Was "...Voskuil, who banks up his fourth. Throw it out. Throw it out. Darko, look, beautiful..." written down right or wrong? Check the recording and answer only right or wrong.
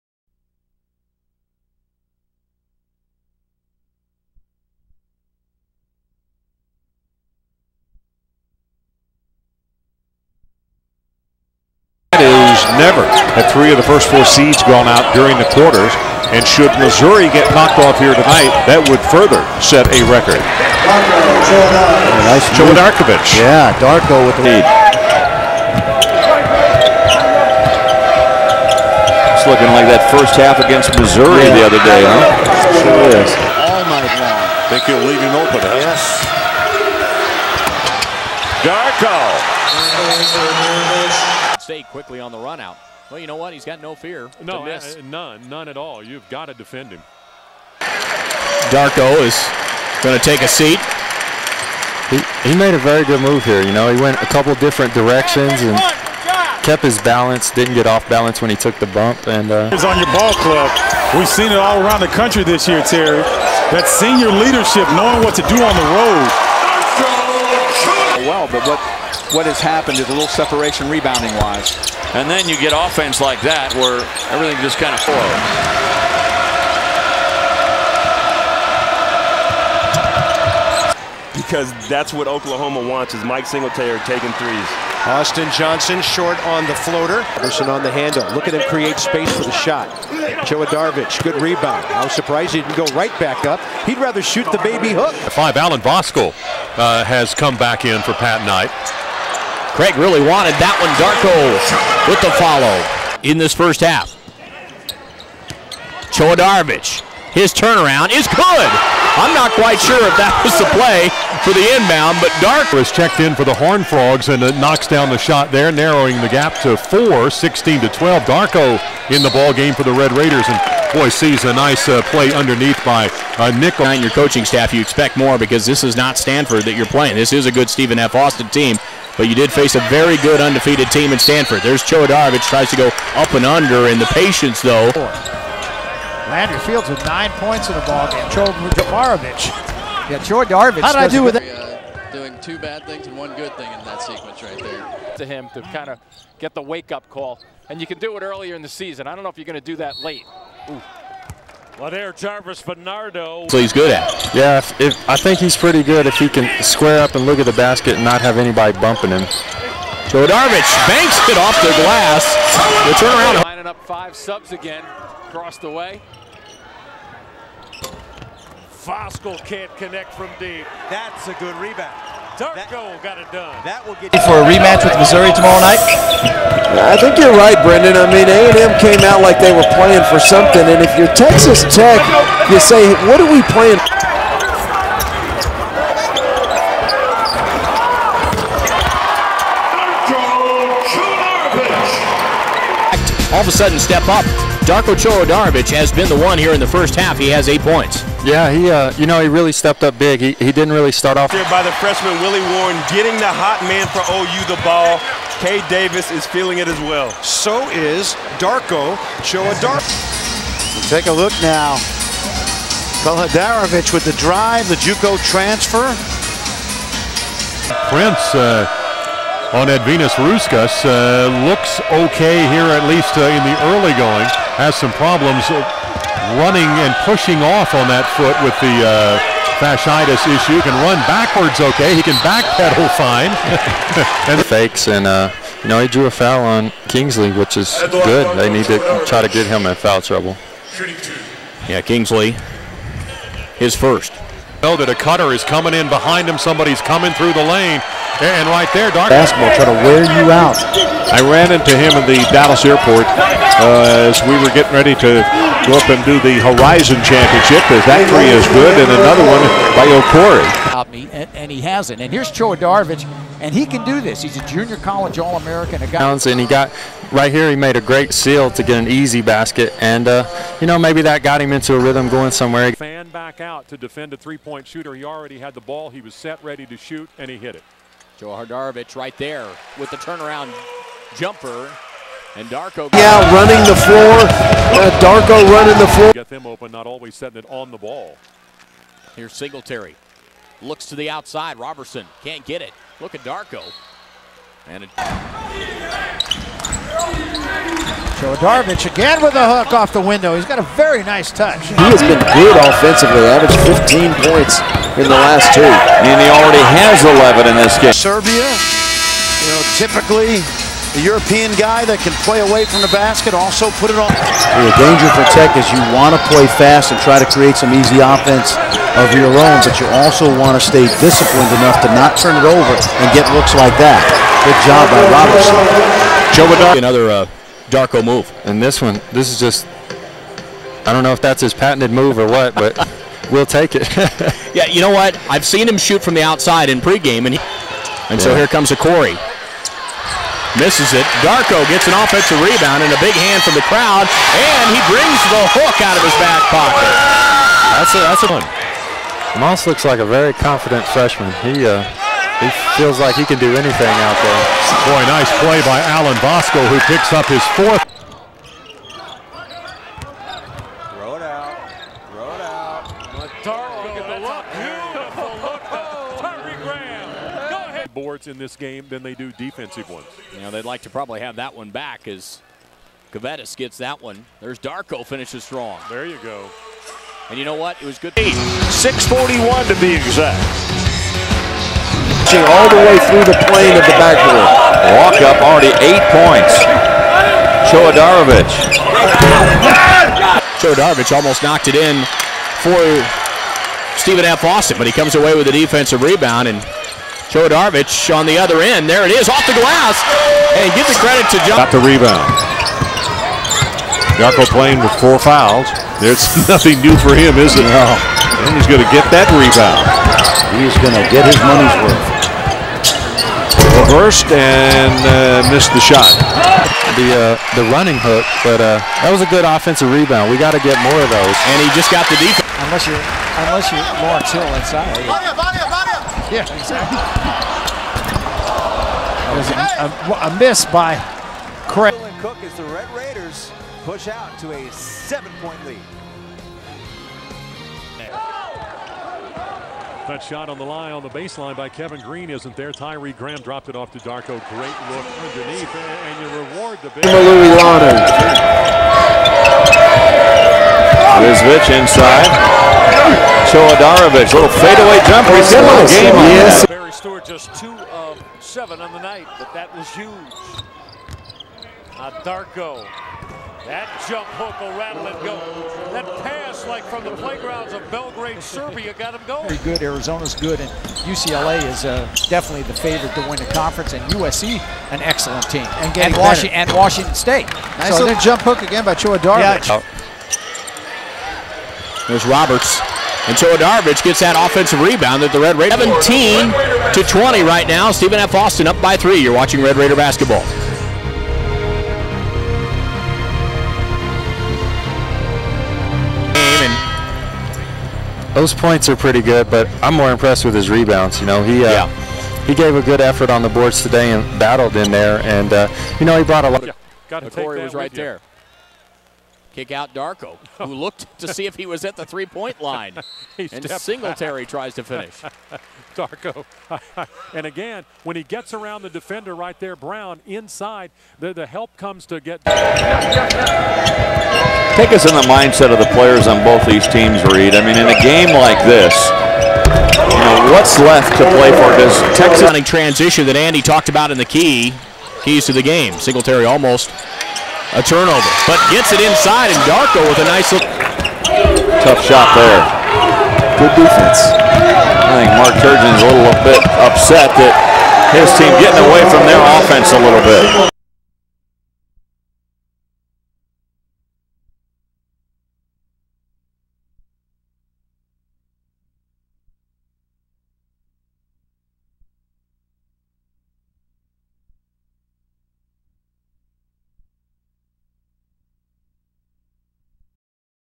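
wrong.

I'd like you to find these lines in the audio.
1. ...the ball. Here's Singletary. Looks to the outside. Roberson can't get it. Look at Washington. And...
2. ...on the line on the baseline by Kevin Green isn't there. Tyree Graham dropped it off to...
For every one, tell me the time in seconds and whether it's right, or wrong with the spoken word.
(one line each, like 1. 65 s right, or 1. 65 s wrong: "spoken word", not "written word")
1. 287 s wrong: "Darko", not "Washington"
2. 440 s right.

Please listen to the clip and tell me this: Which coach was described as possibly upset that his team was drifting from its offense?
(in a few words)
Mark Turgeon.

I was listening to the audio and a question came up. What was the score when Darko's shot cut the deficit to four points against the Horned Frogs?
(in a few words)
16 to 12.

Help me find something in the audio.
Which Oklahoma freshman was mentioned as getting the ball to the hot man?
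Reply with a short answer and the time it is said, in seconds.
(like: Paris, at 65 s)
Willie Warren, at 202 s.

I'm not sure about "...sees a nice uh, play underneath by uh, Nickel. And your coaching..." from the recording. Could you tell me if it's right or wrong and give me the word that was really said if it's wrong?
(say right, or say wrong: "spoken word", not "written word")
right.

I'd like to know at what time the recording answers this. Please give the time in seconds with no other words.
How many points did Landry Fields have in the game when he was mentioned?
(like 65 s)
137 s.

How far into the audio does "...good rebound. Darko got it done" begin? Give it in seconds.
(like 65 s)
171 s.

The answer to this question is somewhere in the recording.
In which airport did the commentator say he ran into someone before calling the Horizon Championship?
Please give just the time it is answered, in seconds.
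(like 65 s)
252 s.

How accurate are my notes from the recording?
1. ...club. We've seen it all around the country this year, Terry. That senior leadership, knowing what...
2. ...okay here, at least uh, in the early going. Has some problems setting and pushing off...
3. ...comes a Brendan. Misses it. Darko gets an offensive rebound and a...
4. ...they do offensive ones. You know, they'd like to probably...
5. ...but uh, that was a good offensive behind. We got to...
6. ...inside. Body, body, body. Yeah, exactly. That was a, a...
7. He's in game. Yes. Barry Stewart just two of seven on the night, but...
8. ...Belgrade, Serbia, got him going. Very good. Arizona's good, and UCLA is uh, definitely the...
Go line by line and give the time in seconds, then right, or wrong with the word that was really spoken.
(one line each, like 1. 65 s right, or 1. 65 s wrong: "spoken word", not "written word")
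1. 60 s right
2. 221 s wrong: "running", not "setting"
3. 338 s wrong: "Corey", not "Brendan"
4. 369 s wrong: "defensive", not "offensive"
5. 418 s wrong: "rebound", not "behind"
6. 424 s right
7. 455 s right
8. 467 s right.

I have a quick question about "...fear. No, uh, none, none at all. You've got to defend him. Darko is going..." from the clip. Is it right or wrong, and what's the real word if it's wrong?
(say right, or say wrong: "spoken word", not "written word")
right.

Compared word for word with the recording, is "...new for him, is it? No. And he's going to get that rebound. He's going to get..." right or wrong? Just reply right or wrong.
right.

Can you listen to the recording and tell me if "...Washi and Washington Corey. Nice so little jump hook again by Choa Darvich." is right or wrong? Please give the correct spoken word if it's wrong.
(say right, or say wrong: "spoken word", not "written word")
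wrong: "State", not "Corey".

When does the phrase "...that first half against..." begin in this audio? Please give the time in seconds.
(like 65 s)
29 s.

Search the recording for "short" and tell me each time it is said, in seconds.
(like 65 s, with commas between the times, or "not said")
86 s.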